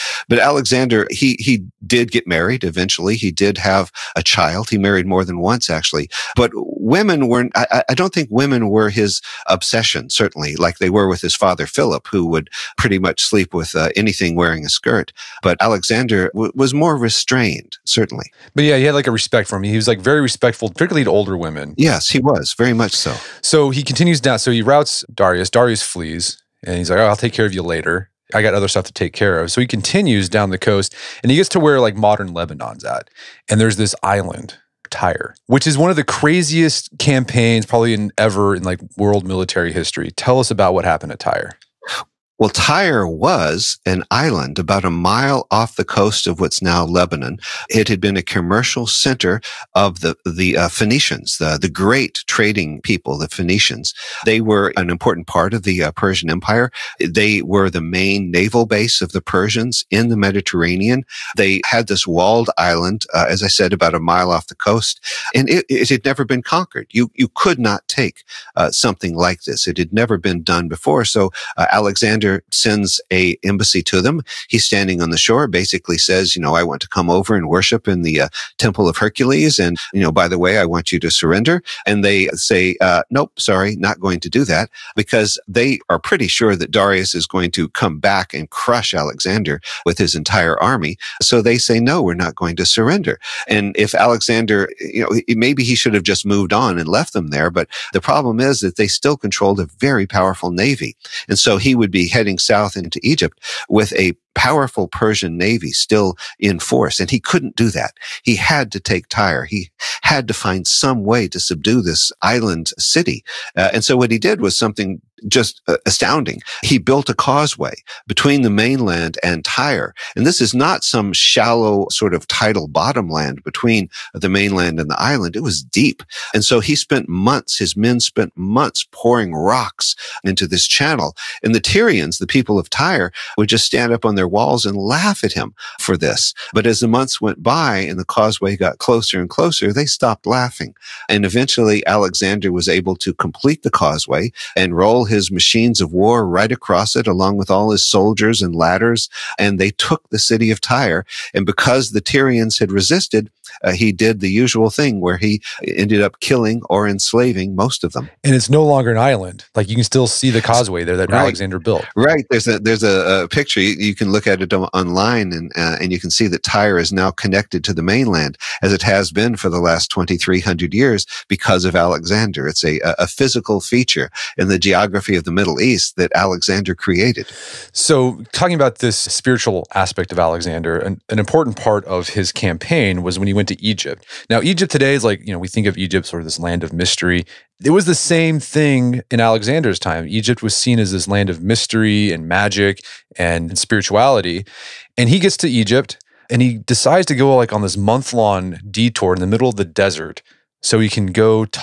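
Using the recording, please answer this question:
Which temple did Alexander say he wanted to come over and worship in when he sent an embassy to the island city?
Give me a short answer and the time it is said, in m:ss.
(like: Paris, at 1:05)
Temple of Hercules, at 1:18.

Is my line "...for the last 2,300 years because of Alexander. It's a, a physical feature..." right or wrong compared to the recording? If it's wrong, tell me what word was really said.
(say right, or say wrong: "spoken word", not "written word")
right.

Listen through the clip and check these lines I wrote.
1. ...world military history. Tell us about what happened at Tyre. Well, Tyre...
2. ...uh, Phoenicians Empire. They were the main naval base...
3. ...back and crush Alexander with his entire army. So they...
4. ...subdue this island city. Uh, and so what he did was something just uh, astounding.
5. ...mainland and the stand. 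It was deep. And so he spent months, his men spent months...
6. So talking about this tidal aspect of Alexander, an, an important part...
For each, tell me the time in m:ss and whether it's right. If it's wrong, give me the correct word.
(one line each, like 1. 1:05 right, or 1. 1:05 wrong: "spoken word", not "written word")
1. 0:38 right
2. 0:55 wrong: "Persian", not "Phoenicians"
3. 1:27 right
4. 1:51 right
5. 2:04 wrong: "island", not "stand"
6. 2:57 wrong: "spiritual", not "tidal".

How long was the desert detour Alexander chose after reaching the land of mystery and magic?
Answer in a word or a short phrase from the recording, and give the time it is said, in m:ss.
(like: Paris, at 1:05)
Month long, at 3:17.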